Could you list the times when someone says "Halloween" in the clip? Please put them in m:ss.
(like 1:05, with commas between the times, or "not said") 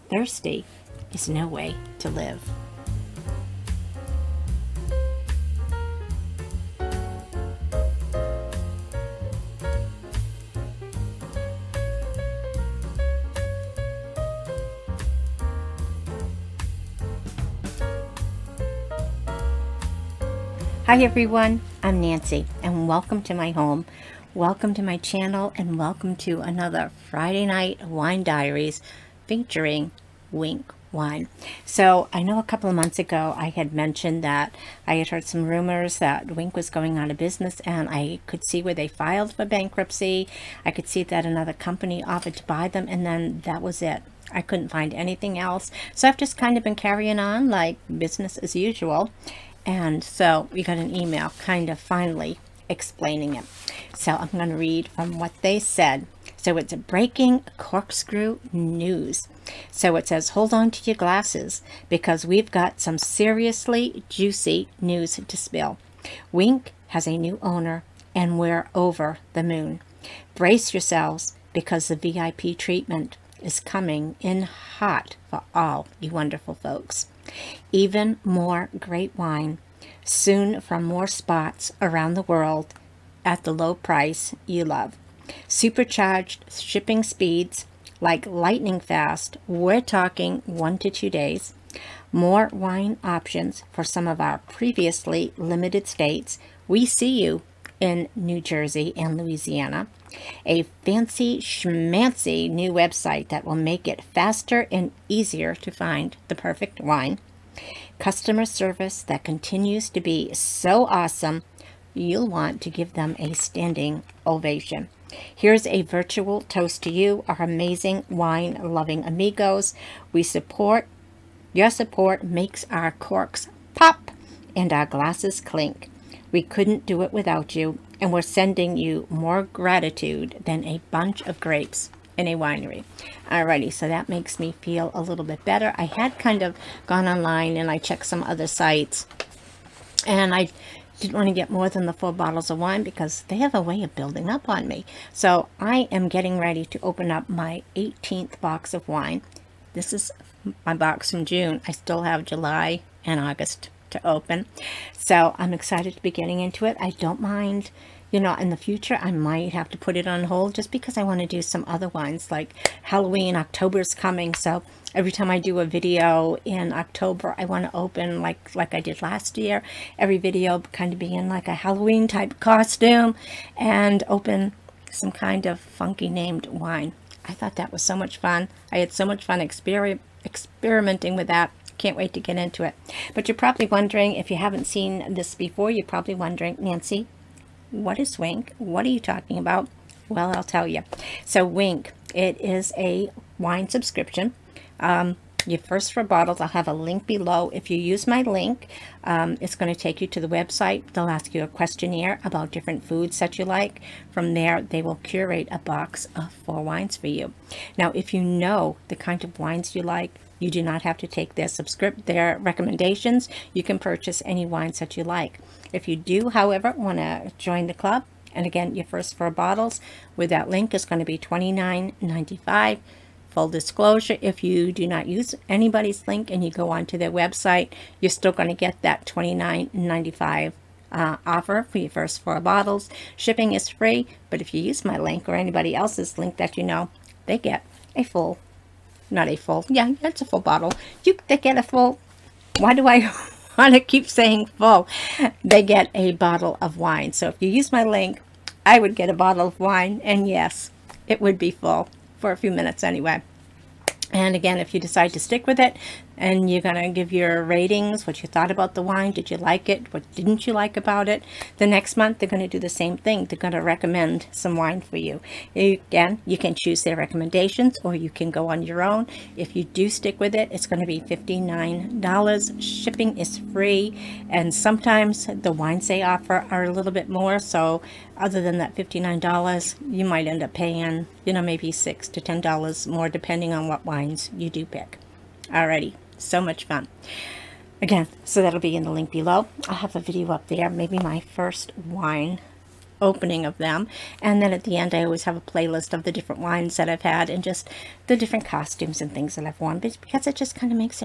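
2:42, 2:51.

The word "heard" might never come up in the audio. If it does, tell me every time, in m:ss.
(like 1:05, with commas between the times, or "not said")
0:35.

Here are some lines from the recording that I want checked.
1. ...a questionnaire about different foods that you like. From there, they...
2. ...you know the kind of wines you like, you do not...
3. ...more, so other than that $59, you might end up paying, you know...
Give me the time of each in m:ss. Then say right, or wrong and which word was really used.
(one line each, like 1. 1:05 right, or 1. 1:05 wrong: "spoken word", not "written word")
1. 3:21 right
2. 3:28 right
3. 4:37 right.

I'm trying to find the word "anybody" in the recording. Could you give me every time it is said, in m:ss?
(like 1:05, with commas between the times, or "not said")
3:45, 3:55.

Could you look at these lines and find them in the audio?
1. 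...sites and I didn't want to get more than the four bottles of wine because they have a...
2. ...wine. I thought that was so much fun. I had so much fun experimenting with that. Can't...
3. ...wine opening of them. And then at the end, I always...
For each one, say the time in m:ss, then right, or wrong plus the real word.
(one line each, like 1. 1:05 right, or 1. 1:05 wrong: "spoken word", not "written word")
1. 2:18 right
2. 2:56 right
3. 4:51 right.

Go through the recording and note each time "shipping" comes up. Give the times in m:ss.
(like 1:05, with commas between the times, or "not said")
1:26, 3:53, 4:32.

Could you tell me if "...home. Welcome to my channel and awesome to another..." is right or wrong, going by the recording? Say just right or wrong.
wrong.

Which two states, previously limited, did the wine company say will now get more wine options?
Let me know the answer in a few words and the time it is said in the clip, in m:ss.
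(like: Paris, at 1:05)
New Jersey and Louisiana, at 1:38.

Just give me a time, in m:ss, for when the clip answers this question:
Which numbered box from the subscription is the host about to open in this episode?
2:27.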